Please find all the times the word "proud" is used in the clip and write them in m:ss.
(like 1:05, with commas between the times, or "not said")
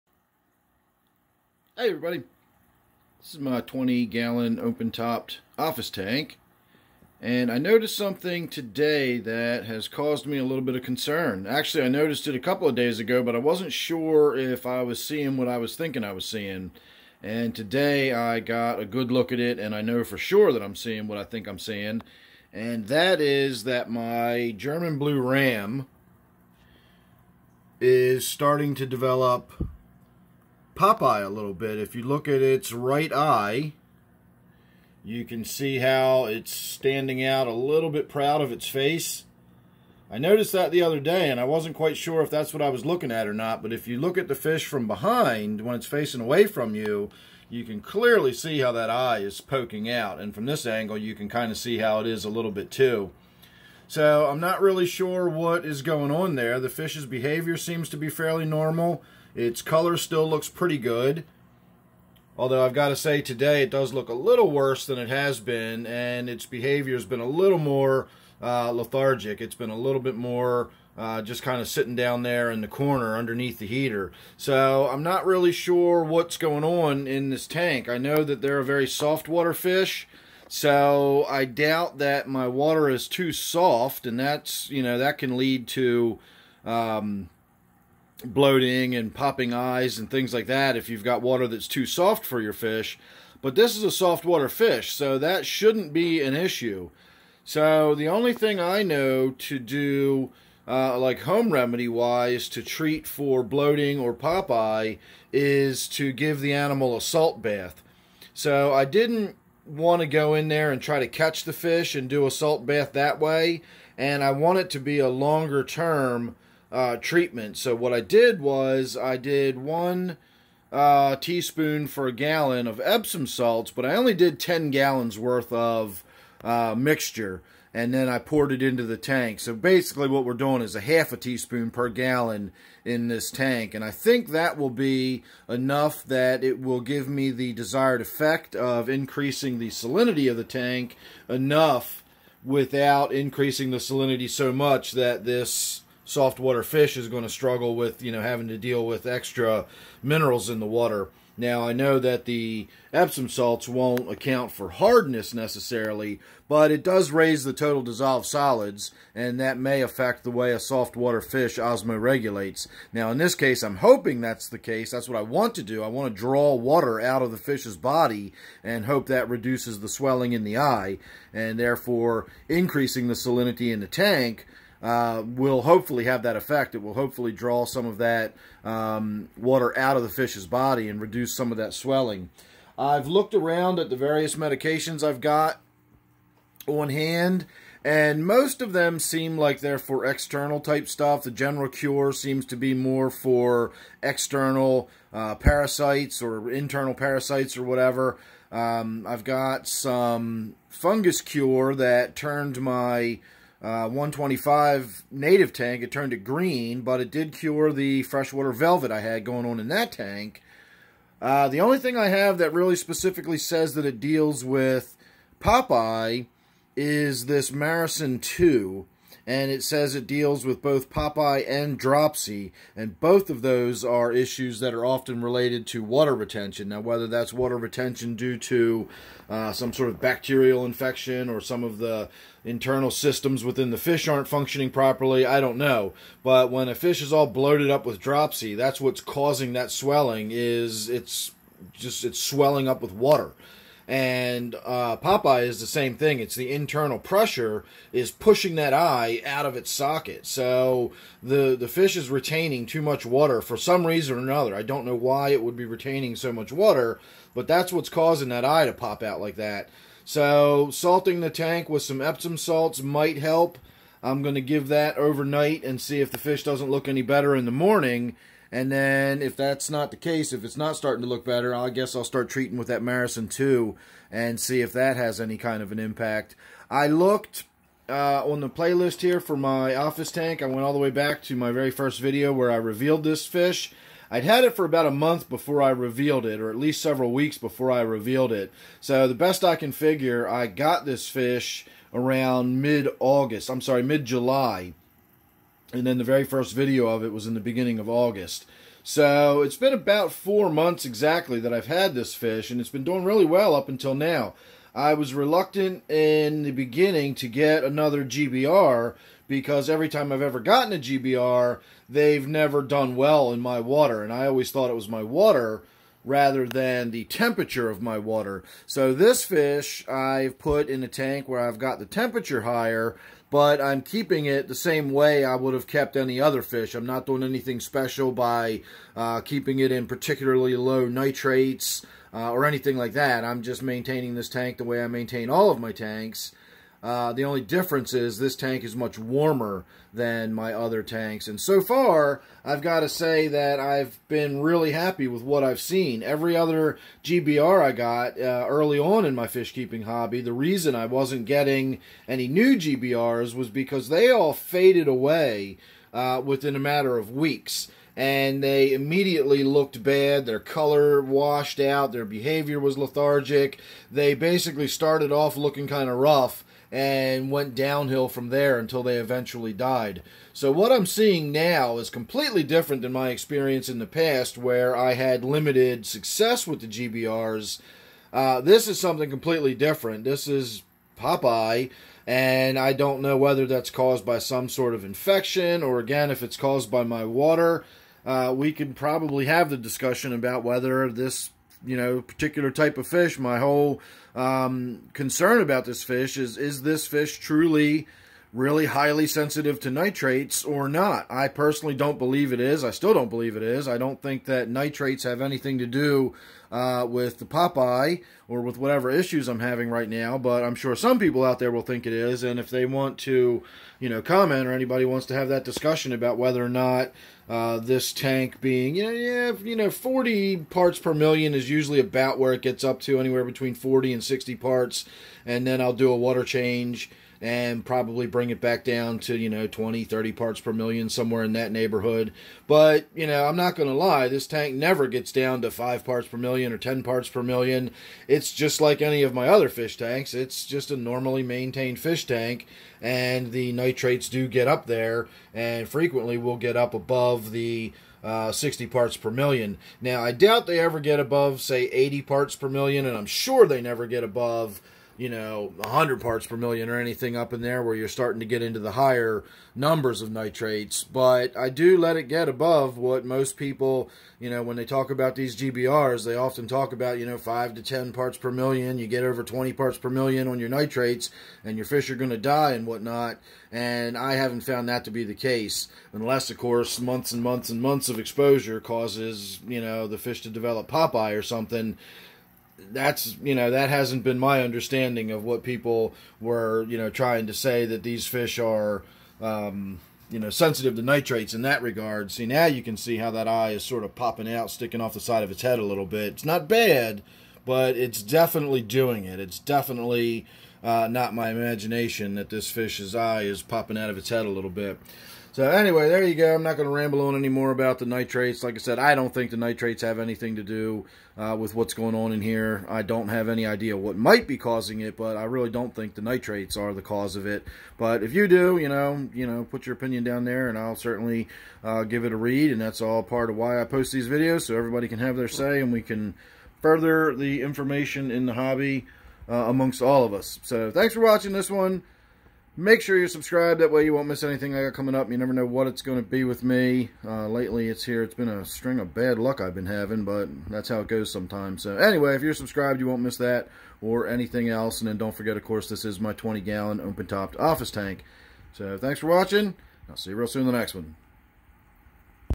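0:38.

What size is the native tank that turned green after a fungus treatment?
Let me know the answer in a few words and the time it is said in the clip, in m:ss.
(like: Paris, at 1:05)
125, at 3:23.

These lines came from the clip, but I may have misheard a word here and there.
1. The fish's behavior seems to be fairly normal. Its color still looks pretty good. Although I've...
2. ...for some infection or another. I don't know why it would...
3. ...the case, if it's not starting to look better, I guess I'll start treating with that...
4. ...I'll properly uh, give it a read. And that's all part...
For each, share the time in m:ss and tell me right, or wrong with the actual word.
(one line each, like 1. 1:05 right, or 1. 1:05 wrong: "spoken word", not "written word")
1. 0:56 right
2. 4:13 wrong: "reason", not "infection"
3. 4:29 right
4. 8:40 wrong: "certainly", not "properly".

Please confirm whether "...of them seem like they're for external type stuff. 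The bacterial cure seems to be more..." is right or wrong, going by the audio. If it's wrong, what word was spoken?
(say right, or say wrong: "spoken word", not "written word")
wrong: "general", not "bacterial".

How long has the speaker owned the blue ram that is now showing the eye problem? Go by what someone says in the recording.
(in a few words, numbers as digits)
about four months.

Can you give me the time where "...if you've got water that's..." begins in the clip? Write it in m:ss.
1:30.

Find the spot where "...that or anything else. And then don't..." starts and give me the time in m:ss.
9:03.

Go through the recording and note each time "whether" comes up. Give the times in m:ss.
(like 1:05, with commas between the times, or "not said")
3:46, 6:23, 6:30, 6:56.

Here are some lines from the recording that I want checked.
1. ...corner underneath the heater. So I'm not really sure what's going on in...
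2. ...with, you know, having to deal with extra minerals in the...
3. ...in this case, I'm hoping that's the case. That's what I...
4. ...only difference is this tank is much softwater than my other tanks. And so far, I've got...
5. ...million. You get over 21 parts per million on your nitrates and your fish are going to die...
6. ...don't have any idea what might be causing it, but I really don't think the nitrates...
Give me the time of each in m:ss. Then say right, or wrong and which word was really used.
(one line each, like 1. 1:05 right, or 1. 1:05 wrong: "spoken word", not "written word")
1. 1:12 right
2. 2:27 right
3. 2:43 right
4. 5:37 wrong: "warmer", not "softwater"
5. 7:48 wrong: "20", not "21"
6. 8:32 right.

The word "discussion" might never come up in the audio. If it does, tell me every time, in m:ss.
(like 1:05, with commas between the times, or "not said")
6:29, 6:55.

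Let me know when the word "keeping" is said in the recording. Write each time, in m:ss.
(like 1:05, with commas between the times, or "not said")
5:23, 5:29, 5:49.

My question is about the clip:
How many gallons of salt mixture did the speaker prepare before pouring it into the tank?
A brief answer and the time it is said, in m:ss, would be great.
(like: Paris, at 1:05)
10, at 2:04.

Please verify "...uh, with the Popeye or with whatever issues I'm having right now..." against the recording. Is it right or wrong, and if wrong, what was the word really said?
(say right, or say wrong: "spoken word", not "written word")
right.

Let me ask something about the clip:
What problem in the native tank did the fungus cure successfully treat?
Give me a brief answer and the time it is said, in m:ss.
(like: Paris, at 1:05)
freshwater velvet, at 3:28.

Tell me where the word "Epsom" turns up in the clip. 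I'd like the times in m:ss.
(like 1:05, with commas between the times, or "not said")
2:02, 2:32, 4:22.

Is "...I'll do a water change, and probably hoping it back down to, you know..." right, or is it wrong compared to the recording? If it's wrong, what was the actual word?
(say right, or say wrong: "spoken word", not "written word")
wrong: "bring", not "hoping".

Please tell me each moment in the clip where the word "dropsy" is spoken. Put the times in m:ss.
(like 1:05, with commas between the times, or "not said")
3:41, 3:57.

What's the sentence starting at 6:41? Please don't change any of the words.
I personally don't believe it is.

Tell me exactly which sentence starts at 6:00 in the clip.
Their color washed out, their behavior was lethargic.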